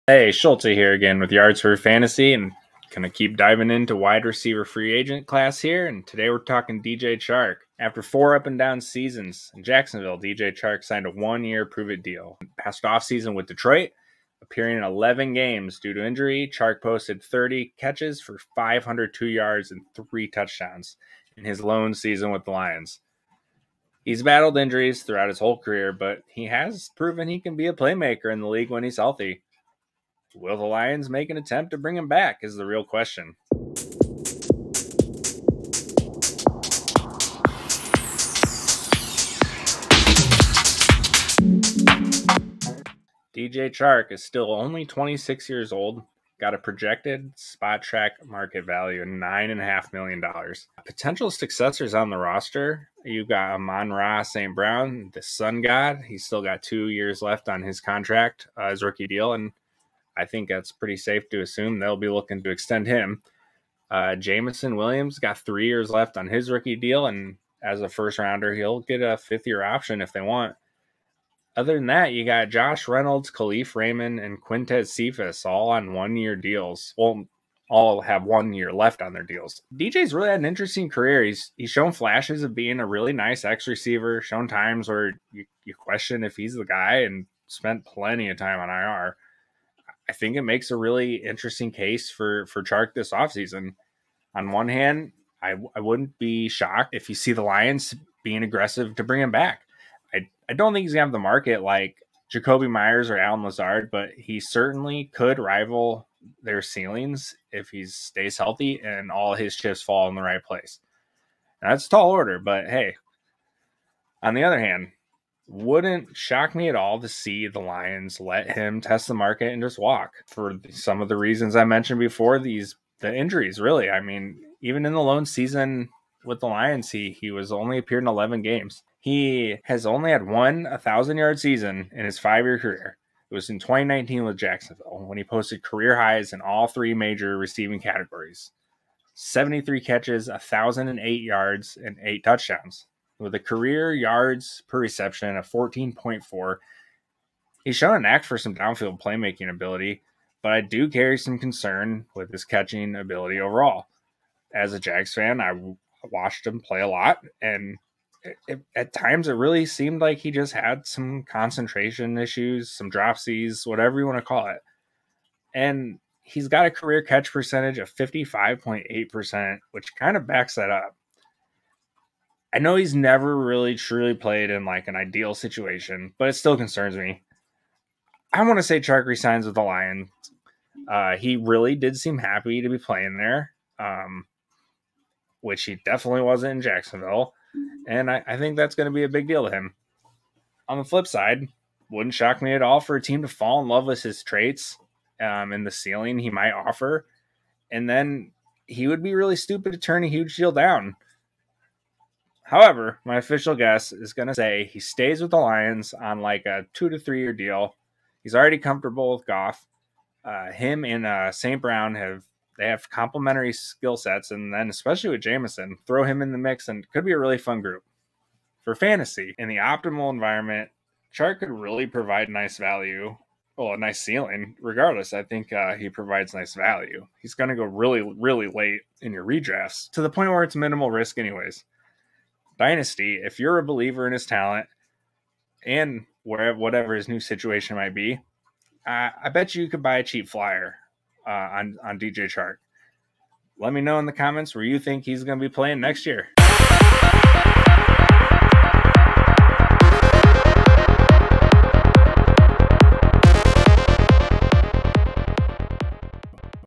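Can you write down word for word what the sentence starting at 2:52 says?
I know he's never really truly played in like an ideal situation, but it still concerns me.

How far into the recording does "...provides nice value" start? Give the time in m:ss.
3:45.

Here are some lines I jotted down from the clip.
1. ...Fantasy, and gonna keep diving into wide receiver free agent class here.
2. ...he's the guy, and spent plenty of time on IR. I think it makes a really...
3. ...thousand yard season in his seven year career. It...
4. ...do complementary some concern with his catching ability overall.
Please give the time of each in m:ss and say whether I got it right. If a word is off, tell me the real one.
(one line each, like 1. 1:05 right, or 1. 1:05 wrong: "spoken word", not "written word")
1. 0:01 right
2. 1:26 right
3. 2:10 wrong: "five", not "seven"
4. 2:30 wrong: "carry", not "complementary".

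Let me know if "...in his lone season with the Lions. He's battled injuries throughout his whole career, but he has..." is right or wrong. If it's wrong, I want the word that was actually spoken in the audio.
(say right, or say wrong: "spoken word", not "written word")
right.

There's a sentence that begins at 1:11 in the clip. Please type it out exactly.
Other than that, you got Josh Reynolds, Kalif Raymond, and Quintez Cephas all on one year deals.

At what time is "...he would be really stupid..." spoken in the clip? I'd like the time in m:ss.
3:18.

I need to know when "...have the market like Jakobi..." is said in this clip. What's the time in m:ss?
1:41.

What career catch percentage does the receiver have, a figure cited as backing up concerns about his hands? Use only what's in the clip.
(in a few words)
55.8%.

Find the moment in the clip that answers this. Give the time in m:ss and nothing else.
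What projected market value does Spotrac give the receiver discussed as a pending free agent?
0:49.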